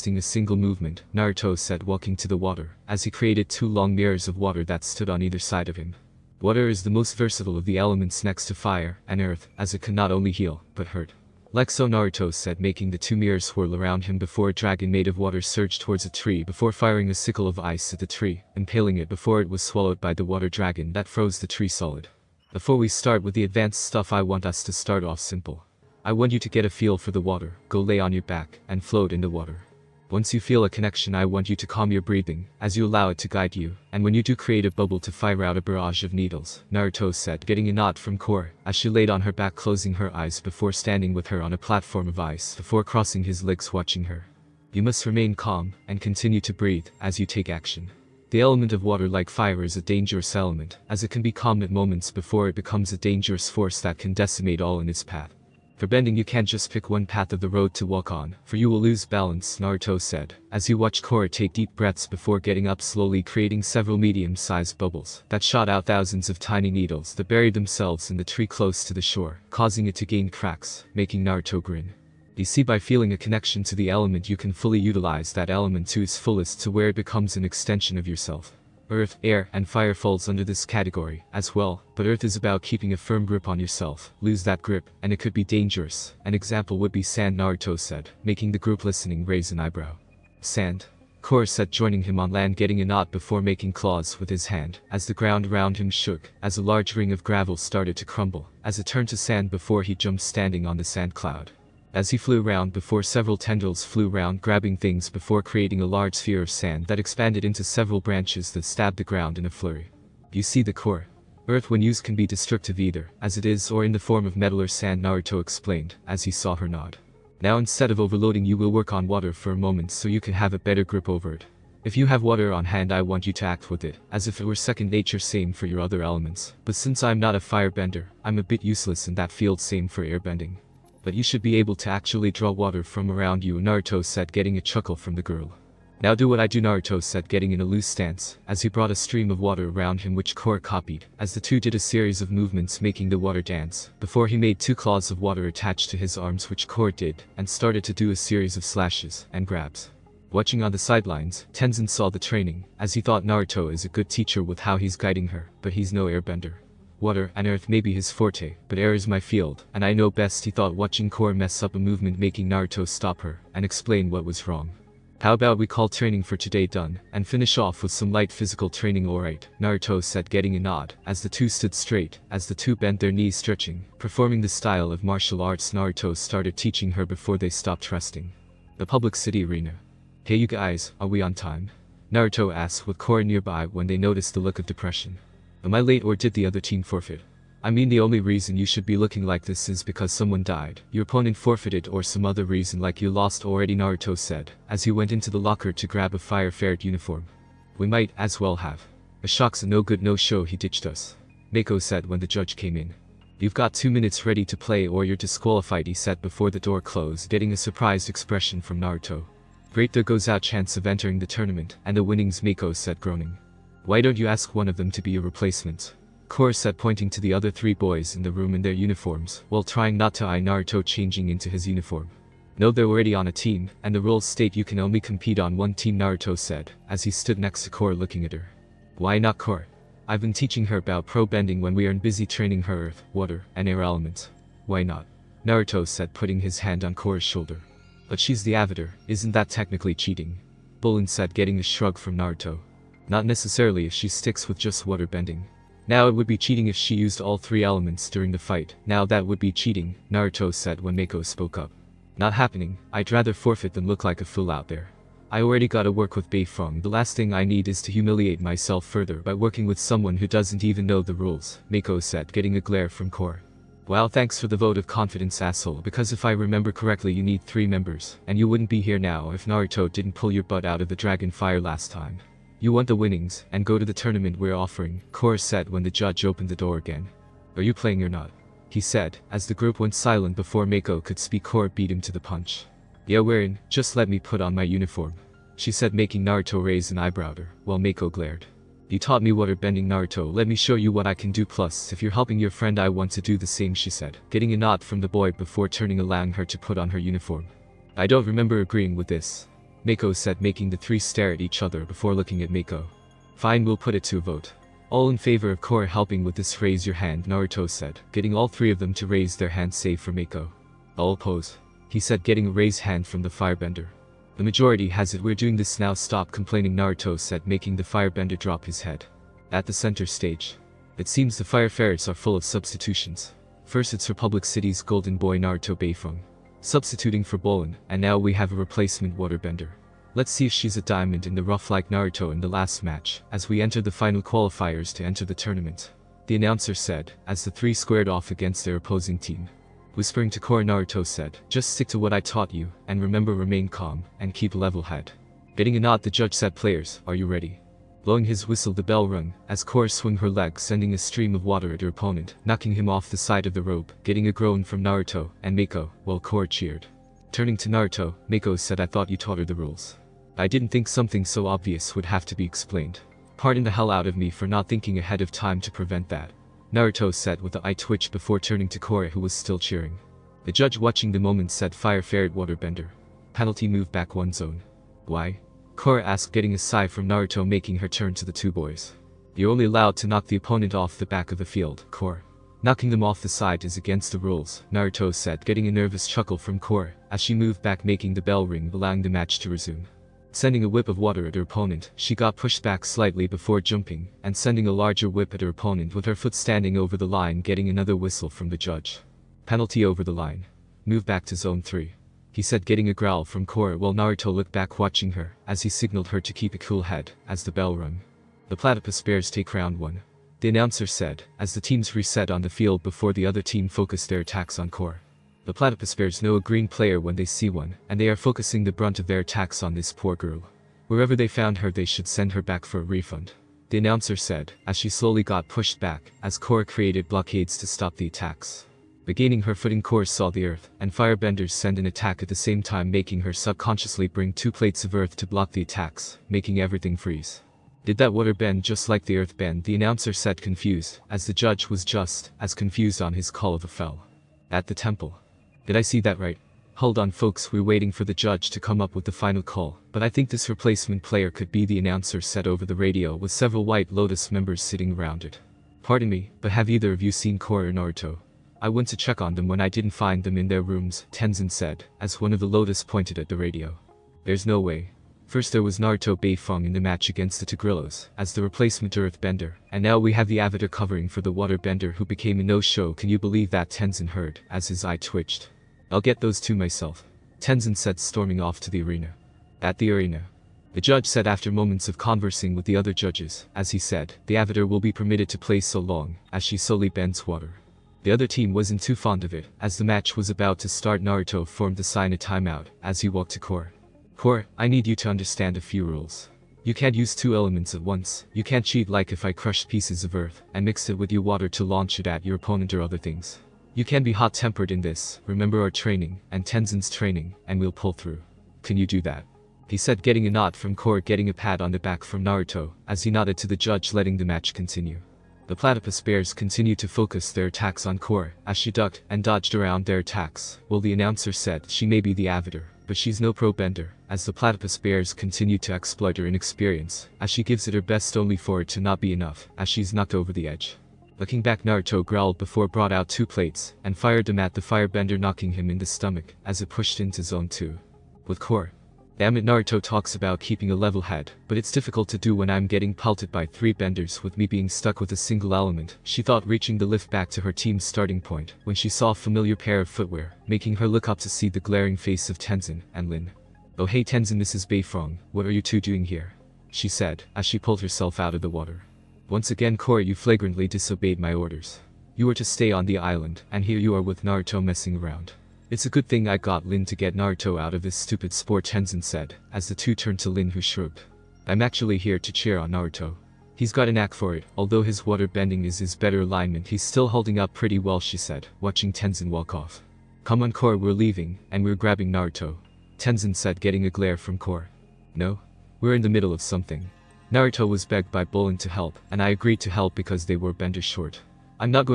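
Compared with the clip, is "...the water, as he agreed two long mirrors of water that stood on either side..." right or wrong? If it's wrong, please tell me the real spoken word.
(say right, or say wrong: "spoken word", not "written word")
wrong: "created", not "agreed".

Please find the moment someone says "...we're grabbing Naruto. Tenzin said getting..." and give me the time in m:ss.
9:41.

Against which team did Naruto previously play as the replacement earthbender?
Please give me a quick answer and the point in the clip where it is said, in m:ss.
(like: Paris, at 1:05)
The Tigerdillos, at 7:47.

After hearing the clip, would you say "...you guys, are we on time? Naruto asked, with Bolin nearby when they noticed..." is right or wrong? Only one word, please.
wrong.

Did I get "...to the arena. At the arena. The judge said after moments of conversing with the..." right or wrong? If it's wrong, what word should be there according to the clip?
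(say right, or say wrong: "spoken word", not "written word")
right.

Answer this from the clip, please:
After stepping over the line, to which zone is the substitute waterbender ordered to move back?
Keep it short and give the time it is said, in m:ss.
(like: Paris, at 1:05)
Zone 3, at 6:41.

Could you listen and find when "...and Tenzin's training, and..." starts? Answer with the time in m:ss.
8:26.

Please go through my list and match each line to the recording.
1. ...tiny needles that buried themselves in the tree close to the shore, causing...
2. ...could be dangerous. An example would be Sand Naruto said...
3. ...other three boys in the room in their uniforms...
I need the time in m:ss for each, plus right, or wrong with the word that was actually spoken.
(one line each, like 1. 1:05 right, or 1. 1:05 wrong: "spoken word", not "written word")
1. 1:06 right
2. 1:25 right
3. 3:37 right.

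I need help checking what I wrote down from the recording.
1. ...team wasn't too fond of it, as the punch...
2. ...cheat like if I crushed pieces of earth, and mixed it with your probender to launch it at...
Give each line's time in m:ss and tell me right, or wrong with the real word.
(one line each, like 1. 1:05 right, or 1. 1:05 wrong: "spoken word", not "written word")
1. 8:08 wrong: "match", not "punch"
2. 8:18 wrong: "water", not "probender".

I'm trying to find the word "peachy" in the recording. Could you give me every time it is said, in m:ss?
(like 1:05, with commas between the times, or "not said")
not said.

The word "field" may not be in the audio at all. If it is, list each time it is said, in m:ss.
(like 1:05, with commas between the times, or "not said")
2:09, 2:39, 6:21, 6:52.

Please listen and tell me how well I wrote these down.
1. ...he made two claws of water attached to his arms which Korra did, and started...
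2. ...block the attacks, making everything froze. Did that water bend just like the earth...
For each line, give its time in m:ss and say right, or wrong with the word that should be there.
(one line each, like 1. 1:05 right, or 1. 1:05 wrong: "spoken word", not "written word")
1. 2:24 right
2. 7:15 wrong: "freeze", not "froze".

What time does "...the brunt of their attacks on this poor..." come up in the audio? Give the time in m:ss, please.
6:58.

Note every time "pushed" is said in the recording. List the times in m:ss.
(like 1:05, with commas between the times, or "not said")
6:32, 7:05, 8:56.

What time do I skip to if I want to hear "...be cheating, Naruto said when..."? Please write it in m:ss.
4:09.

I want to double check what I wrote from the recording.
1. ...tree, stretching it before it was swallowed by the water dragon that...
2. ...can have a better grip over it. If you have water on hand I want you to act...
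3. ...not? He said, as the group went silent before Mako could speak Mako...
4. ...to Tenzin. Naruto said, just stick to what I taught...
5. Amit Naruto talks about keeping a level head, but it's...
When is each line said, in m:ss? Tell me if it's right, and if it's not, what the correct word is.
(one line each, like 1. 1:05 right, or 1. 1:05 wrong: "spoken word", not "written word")
1. 0:18 wrong: "impaling", not "stretching"
2. 2:00 right
3. 4:38 wrong: "Korra", not "Mako"
4. 5:40 wrong: "Korra", not "Tenzin"
5. 8:59 right.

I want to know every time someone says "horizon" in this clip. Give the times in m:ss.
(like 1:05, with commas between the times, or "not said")
not said.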